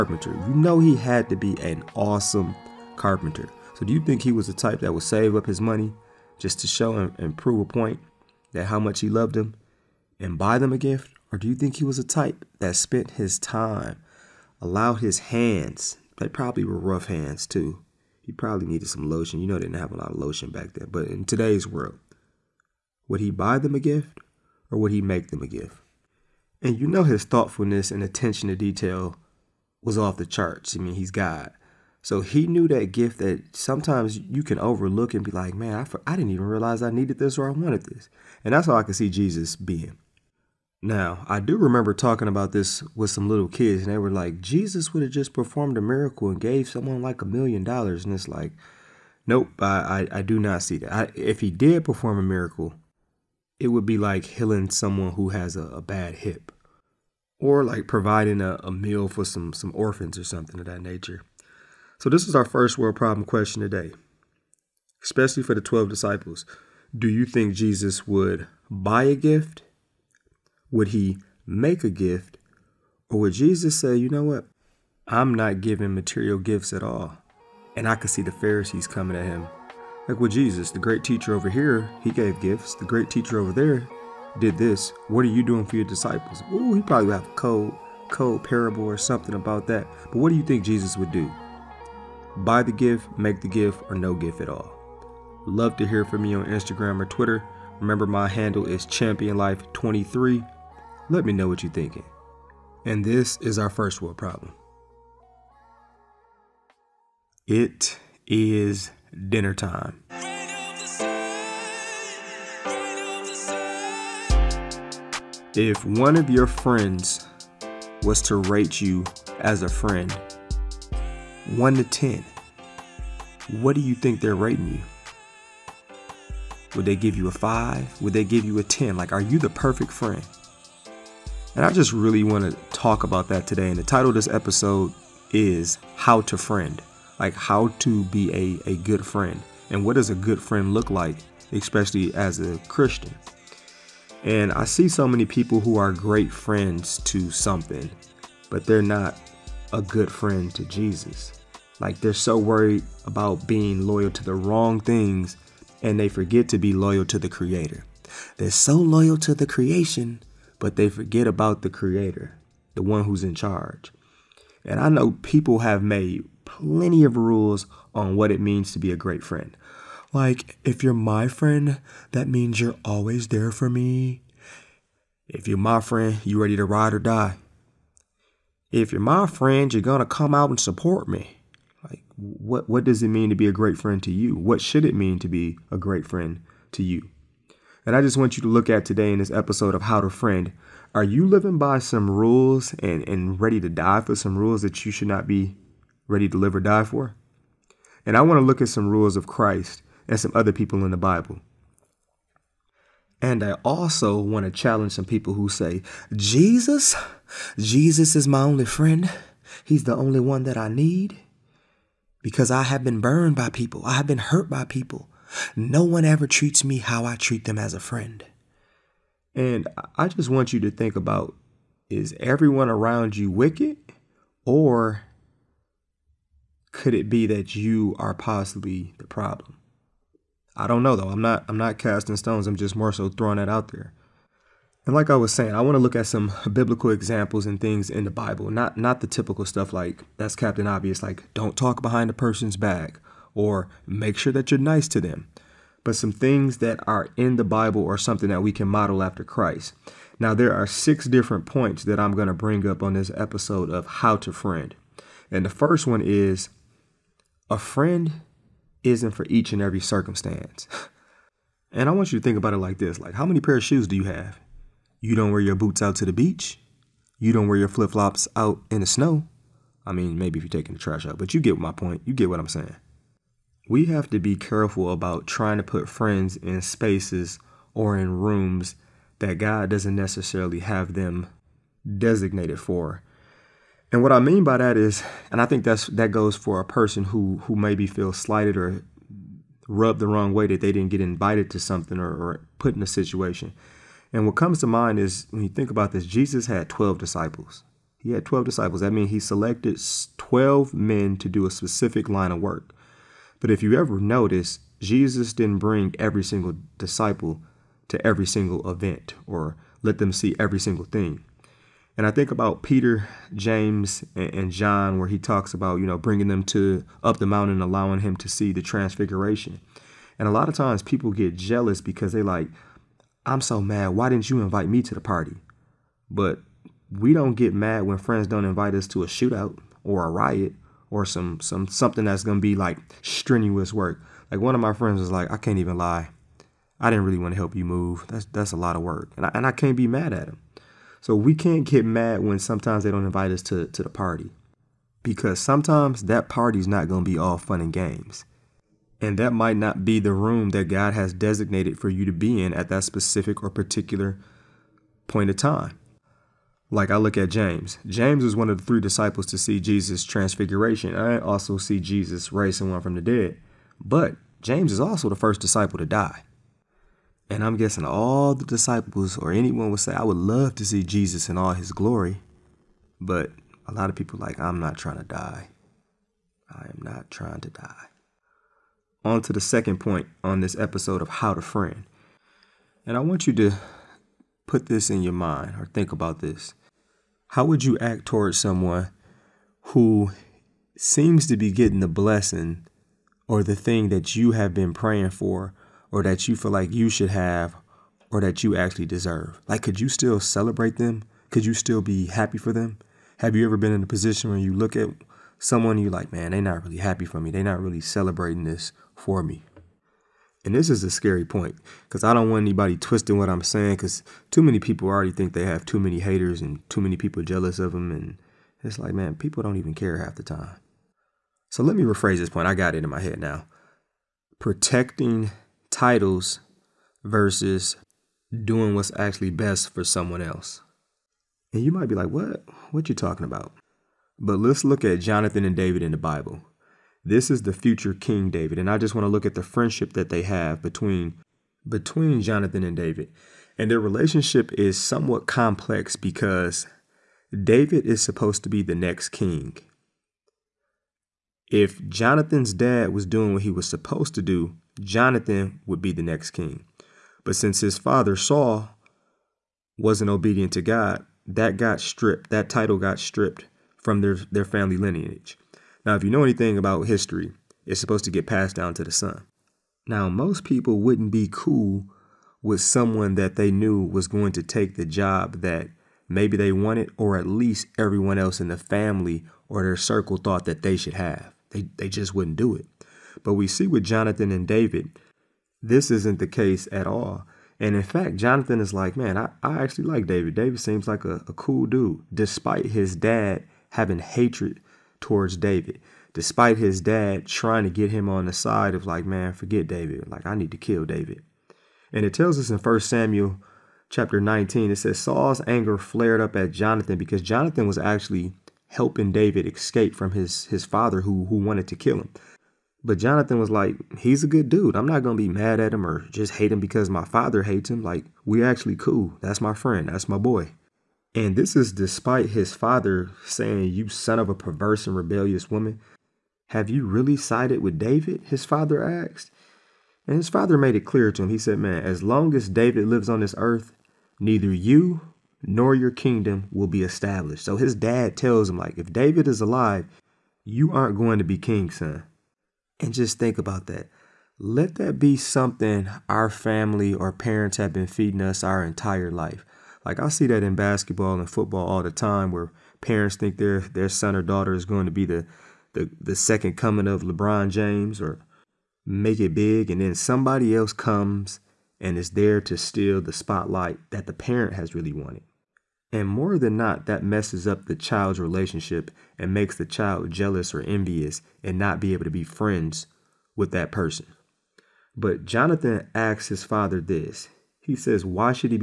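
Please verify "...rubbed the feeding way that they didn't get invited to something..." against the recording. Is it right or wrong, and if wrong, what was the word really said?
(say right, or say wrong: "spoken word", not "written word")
wrong: "wrong", not "feeding".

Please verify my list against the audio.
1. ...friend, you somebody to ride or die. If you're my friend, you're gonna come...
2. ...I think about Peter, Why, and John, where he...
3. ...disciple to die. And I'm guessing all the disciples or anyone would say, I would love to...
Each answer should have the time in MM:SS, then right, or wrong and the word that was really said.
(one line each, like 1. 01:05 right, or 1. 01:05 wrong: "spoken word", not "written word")
1. 02:55 wrong: "ready", not "somebody"
2. 05:12 wrong: "James", not "Why"
3. 06:05 right.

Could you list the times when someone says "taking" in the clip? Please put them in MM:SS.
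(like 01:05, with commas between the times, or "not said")
04:30.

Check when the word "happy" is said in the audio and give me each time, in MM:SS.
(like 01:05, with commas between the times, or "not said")
06:42, 06:46.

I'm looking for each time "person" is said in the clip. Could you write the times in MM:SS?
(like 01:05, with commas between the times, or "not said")
04:02, 04:46, 09:33.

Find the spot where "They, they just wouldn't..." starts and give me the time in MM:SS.
08:01.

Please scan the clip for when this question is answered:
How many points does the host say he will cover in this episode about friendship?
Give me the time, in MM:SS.
04:10.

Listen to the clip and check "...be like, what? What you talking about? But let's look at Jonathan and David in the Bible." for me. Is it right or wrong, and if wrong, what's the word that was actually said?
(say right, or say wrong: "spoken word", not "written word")
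right.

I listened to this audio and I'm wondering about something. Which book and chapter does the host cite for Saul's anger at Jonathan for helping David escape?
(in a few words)
1 Samuel 19.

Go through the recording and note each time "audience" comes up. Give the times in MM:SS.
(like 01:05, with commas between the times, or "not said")
not said.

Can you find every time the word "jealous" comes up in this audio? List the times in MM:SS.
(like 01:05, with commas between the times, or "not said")
05:21, 06:57, 09:30.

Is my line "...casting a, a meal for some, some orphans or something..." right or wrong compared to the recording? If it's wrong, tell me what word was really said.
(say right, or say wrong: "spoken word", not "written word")
wrong: "providing", not "casting".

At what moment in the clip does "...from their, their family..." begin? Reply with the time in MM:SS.
07:43.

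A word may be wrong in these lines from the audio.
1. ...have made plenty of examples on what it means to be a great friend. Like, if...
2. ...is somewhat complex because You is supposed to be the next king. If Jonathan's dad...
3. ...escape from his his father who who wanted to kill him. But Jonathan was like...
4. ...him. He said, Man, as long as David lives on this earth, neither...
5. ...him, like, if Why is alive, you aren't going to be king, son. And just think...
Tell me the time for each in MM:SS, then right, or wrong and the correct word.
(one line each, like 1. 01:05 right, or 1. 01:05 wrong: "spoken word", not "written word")
1. 02:45 wrong: "rules", not "examples"
2. 07:24 wrong: "David", not "You"
3. 08:29 right
4. 08:51 right
5. 08:58 wrong: "David", not "Why".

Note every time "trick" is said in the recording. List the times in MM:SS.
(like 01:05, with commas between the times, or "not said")
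not said.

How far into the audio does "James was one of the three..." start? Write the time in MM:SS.
05:57.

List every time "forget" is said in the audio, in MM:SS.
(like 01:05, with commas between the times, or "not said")
02:36, 02:40, 08:19.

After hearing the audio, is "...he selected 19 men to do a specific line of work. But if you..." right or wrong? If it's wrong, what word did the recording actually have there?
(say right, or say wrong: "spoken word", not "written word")
wrong: "12", not "19".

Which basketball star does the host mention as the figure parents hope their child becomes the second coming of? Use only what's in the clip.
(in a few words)
LeBron James.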